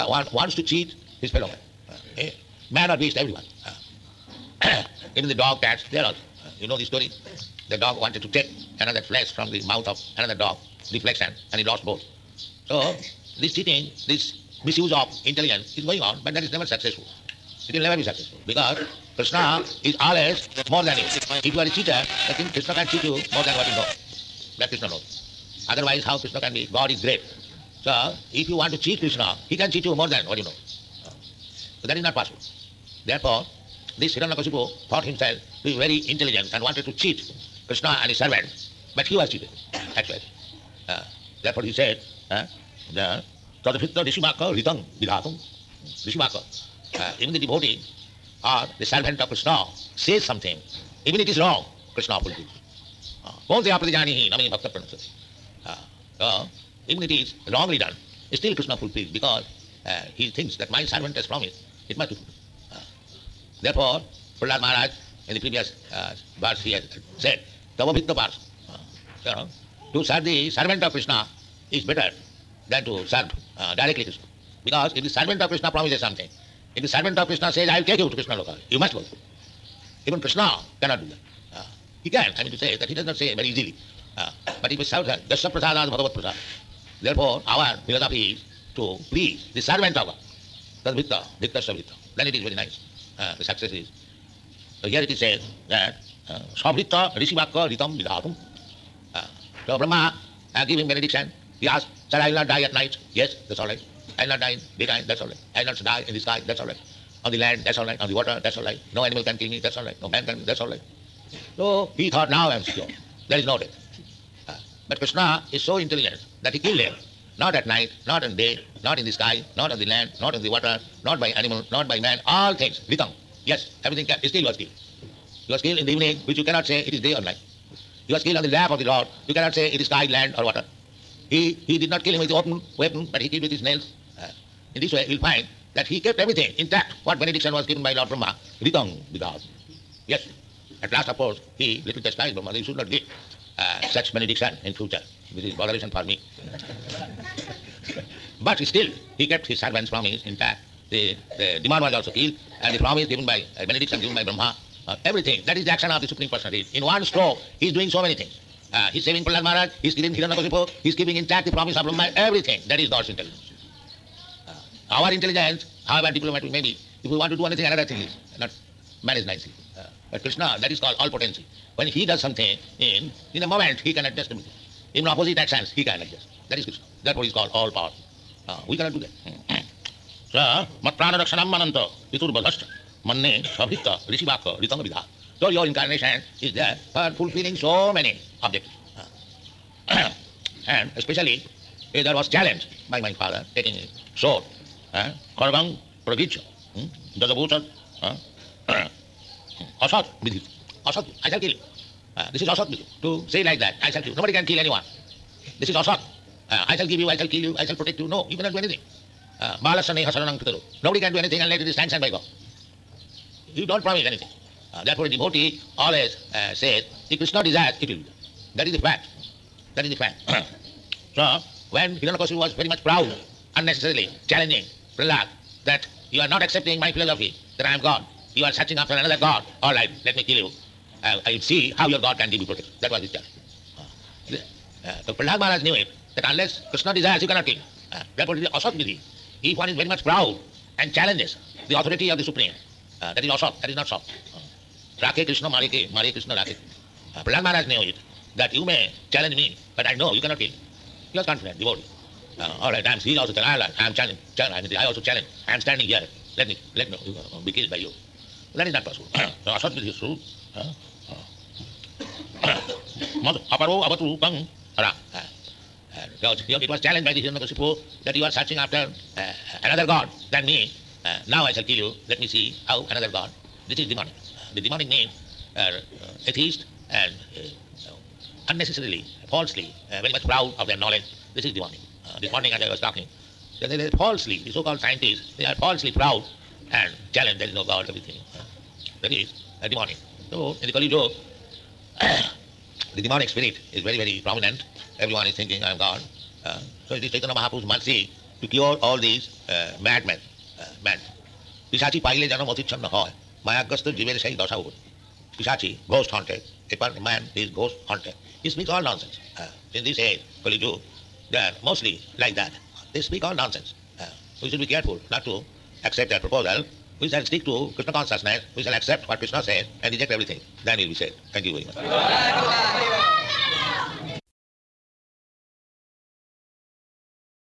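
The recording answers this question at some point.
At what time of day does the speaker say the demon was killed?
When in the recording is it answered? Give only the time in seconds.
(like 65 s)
125 s.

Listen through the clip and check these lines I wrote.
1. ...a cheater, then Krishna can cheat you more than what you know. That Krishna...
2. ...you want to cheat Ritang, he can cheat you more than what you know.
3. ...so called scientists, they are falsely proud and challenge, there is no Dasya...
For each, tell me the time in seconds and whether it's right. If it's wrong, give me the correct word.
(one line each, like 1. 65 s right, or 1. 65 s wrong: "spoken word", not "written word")
1. 21 s right
2. 28 s wrong: "Krishna", not "Ritang"
3. 284 s wrong: "God", not "Dasya".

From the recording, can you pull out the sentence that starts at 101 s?
He asked, Sir, I will not die at night.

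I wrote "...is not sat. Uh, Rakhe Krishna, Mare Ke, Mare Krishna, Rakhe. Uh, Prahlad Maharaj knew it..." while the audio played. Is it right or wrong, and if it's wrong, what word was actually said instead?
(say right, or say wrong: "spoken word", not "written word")
right.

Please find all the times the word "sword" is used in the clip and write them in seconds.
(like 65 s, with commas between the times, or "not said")
194 s, 259 s.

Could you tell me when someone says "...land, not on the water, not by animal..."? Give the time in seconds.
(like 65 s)
119 s.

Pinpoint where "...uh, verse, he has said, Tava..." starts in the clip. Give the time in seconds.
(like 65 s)
65 s.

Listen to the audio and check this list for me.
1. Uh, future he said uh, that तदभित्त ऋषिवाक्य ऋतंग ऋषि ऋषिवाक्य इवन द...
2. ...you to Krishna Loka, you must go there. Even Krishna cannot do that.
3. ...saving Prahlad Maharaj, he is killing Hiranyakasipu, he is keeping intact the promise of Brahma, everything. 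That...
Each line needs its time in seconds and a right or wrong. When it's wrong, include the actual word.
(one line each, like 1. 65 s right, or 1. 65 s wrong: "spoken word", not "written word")
1. 40 s wrong: "therefore", not "future"
2. 77 s right
3. 159 s right.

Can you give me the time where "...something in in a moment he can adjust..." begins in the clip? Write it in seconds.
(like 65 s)
172 s.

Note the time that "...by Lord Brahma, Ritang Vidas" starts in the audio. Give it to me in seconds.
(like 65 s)
137 s.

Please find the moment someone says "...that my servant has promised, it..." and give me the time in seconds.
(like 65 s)
60 s.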